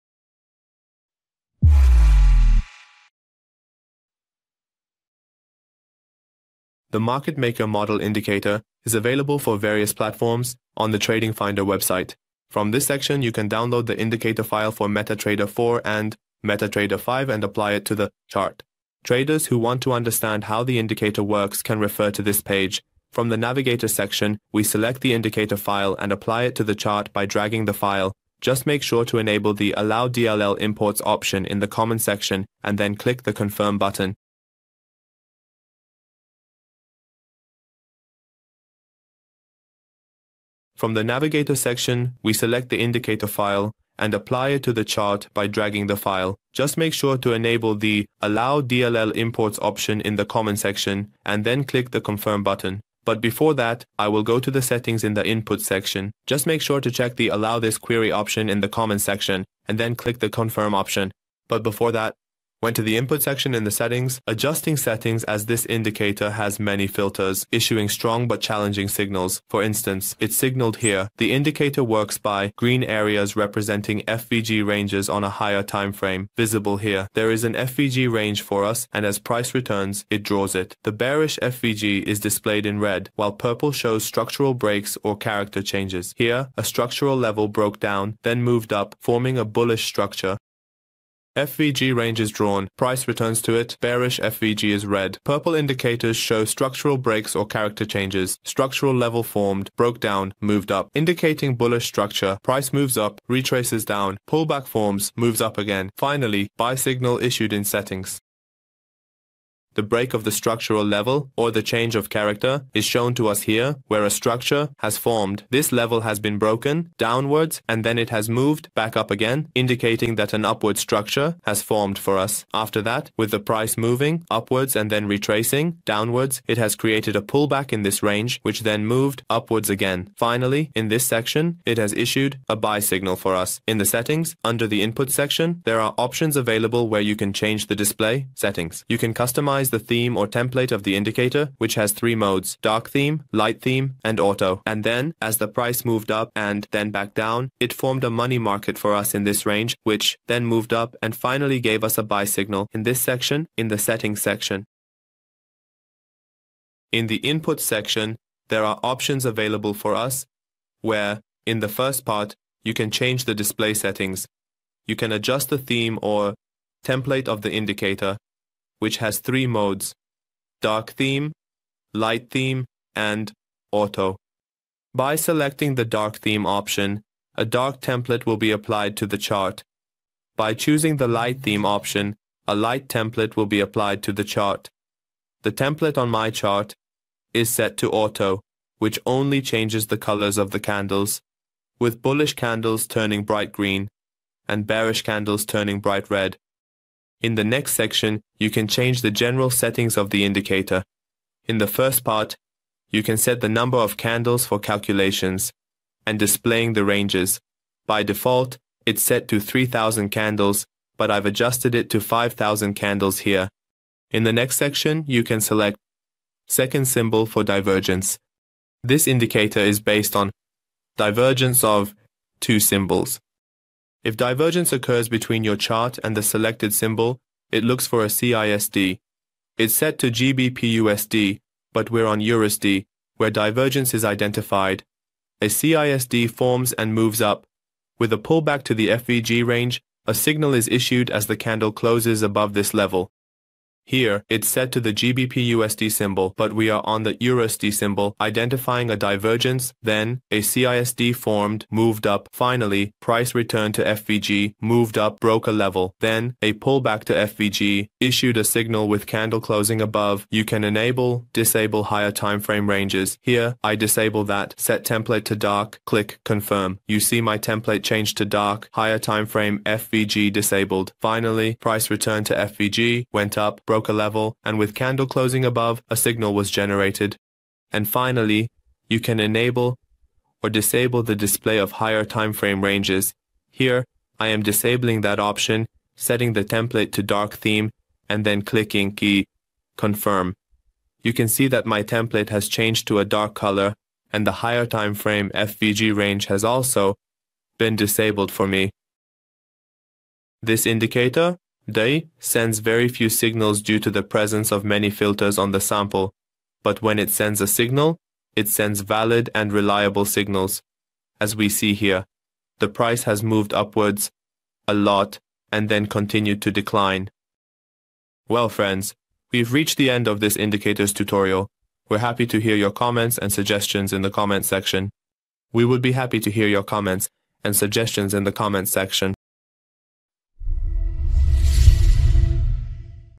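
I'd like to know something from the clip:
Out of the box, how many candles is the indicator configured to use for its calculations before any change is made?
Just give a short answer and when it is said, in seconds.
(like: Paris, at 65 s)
3000, at 209 s.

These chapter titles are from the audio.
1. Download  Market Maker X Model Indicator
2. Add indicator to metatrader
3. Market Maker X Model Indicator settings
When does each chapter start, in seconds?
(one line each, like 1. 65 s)
1. 15 s
2. 40 s
3. 150 s.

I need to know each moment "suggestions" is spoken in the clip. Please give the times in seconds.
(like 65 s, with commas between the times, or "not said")
323 s, 327 s.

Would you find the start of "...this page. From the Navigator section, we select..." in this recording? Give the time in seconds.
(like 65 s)
22 s.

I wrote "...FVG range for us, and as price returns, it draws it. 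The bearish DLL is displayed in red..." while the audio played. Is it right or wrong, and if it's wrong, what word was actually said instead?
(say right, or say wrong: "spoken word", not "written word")
wrong: "FVG", not "DLL".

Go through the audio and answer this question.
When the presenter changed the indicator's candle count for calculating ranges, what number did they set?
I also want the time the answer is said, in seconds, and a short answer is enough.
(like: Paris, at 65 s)
5000, at 212 s.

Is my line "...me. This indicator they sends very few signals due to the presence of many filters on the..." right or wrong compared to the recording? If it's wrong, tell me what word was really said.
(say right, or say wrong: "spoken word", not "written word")
right.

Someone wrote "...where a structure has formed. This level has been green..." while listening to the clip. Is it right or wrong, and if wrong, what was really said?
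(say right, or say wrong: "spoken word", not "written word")
wrong: "broken", not "green".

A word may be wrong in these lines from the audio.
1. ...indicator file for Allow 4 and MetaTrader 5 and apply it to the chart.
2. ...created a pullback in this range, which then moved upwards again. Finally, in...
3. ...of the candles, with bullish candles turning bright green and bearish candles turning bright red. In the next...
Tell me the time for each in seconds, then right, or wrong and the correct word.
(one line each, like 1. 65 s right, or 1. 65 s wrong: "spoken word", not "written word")
1. 13 s wrong: "MetaTrader", not "Allow"
2. 126 s right
3. 190 s right.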